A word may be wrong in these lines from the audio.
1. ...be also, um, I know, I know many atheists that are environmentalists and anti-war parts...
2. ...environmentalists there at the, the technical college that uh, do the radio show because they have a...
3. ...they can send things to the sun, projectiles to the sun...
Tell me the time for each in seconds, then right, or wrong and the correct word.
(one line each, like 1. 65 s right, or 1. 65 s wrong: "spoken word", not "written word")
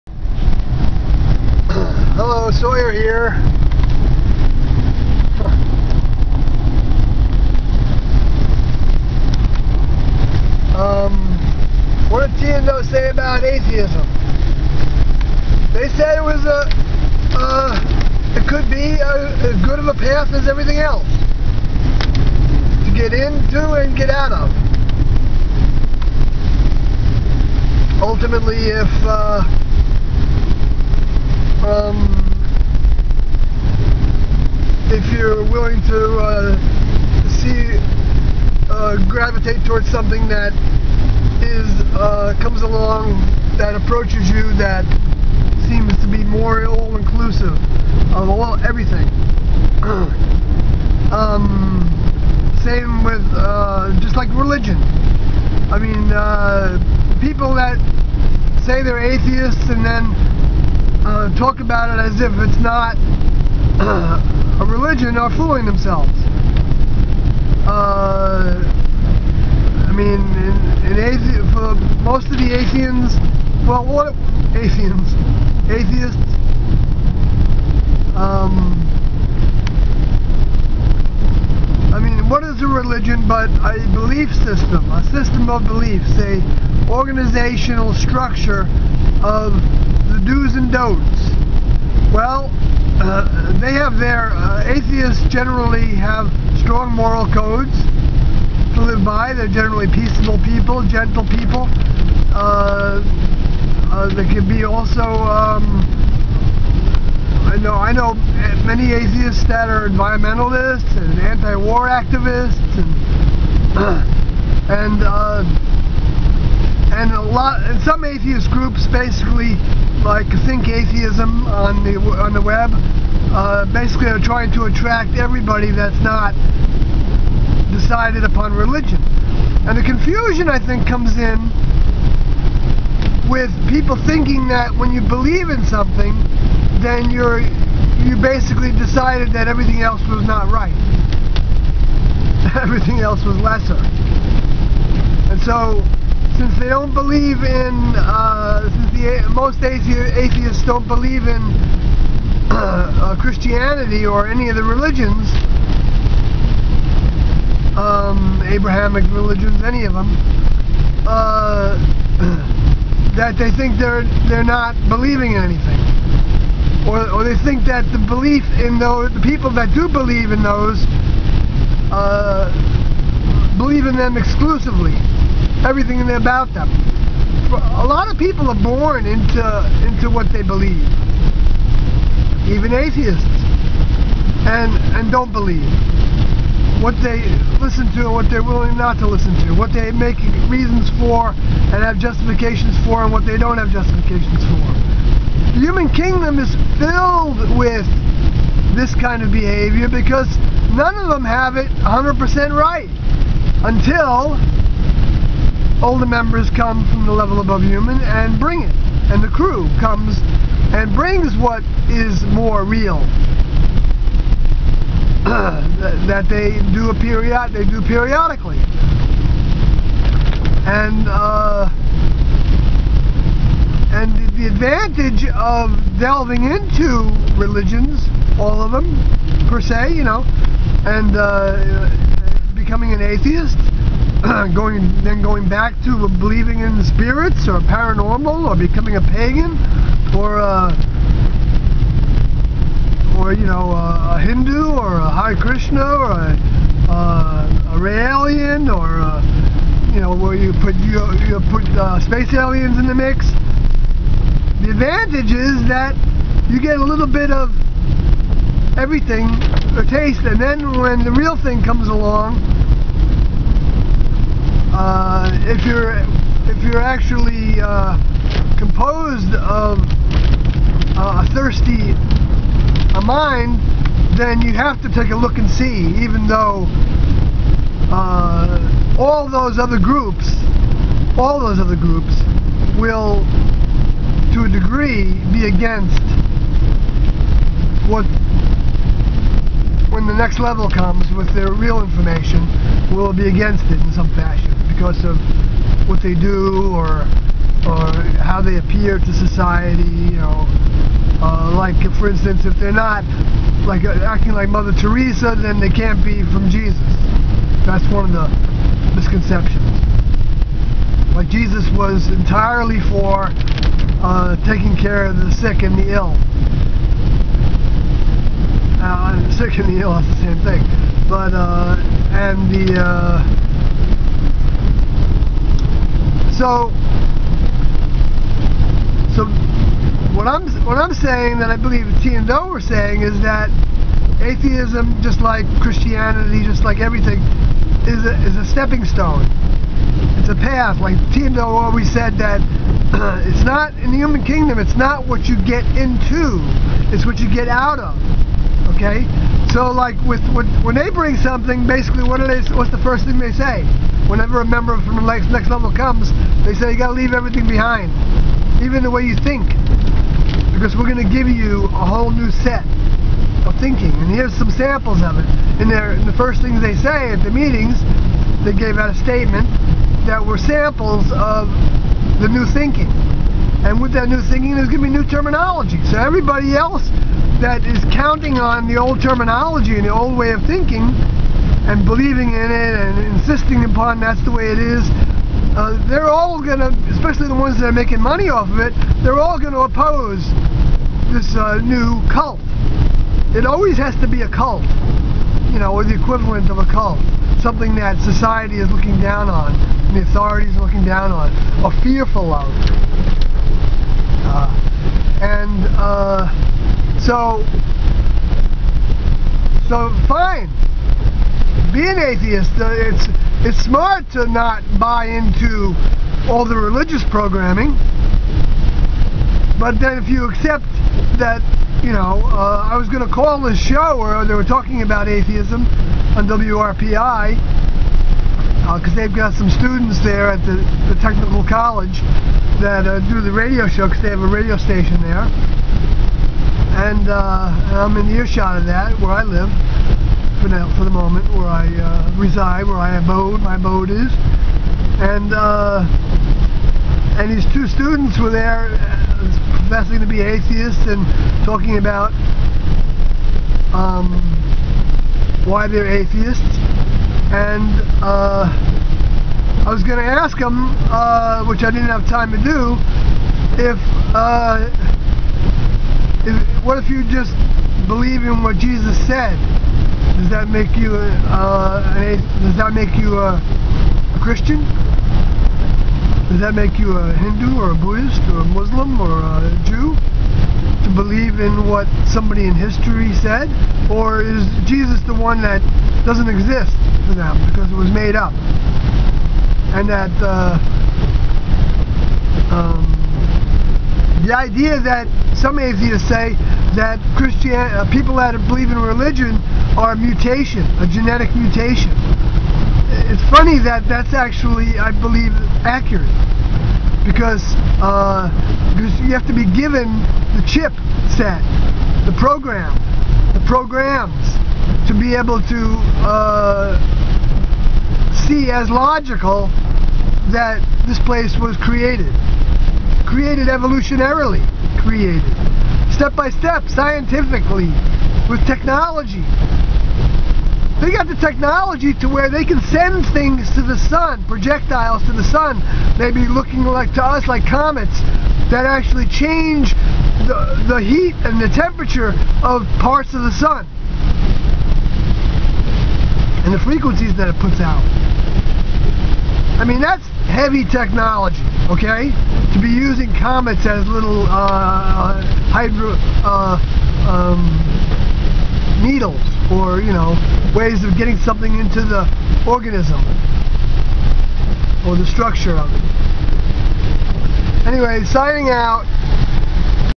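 1. 104 s wrong: "activists", not "parts"
2. 429 s wrong: "students", not "environmentalists"
3. 532 s right.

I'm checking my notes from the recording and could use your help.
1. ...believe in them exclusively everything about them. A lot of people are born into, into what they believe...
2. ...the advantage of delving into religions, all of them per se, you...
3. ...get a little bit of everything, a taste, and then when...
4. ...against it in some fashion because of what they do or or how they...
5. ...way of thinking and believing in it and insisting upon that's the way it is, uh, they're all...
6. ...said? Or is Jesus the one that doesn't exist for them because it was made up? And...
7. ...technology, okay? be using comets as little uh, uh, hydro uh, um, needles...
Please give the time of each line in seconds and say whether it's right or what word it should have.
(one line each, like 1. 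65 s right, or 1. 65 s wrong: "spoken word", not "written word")
1. 173 s right
2. 224 s right
3. 256 s right
4. 293 s right
5. 380 s right
6. 483 s right
7. 550 s right.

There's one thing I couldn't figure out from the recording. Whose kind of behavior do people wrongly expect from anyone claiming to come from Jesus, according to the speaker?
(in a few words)
Mother Teresa.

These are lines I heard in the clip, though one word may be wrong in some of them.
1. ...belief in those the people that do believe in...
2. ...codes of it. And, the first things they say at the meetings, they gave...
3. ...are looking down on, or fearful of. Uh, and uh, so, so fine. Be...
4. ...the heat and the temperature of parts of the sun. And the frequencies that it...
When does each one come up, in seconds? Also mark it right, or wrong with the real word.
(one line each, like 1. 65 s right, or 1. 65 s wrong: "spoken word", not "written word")
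1. 168 s right
2. 364 s wrong: "samples", not "codes"
3. 400 s right
4. 540 s right.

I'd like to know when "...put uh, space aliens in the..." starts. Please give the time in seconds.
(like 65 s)
251 s.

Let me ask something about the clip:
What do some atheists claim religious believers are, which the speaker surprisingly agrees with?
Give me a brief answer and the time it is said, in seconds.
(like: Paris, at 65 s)
A genetic mutation, at 500 s.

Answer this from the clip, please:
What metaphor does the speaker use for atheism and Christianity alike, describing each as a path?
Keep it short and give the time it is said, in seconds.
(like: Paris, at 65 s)
stepping stone, at 338 s.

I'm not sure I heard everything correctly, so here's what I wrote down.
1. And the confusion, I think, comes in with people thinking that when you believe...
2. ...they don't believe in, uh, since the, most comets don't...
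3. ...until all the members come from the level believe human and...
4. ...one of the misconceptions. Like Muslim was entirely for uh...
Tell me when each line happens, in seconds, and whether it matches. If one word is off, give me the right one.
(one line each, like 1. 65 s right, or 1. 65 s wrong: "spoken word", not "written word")
1. 129 s right
2. 146 s wrong: "atheists", not "comets"
3. 203 s wrong: "above", not "believe"
4. 307 s wrong: "Jesus", not "Muslim".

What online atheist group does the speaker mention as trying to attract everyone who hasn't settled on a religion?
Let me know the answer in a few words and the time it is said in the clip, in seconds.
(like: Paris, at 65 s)
Think Atheism, at 120 s.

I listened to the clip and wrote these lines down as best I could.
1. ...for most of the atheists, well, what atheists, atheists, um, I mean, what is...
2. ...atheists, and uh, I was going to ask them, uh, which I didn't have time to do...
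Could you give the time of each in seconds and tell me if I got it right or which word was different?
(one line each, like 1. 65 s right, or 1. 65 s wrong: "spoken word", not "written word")
1. 71 s right
2. 455 s right.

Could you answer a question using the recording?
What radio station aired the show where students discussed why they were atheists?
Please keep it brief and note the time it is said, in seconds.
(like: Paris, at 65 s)
WRPI, at 426 s.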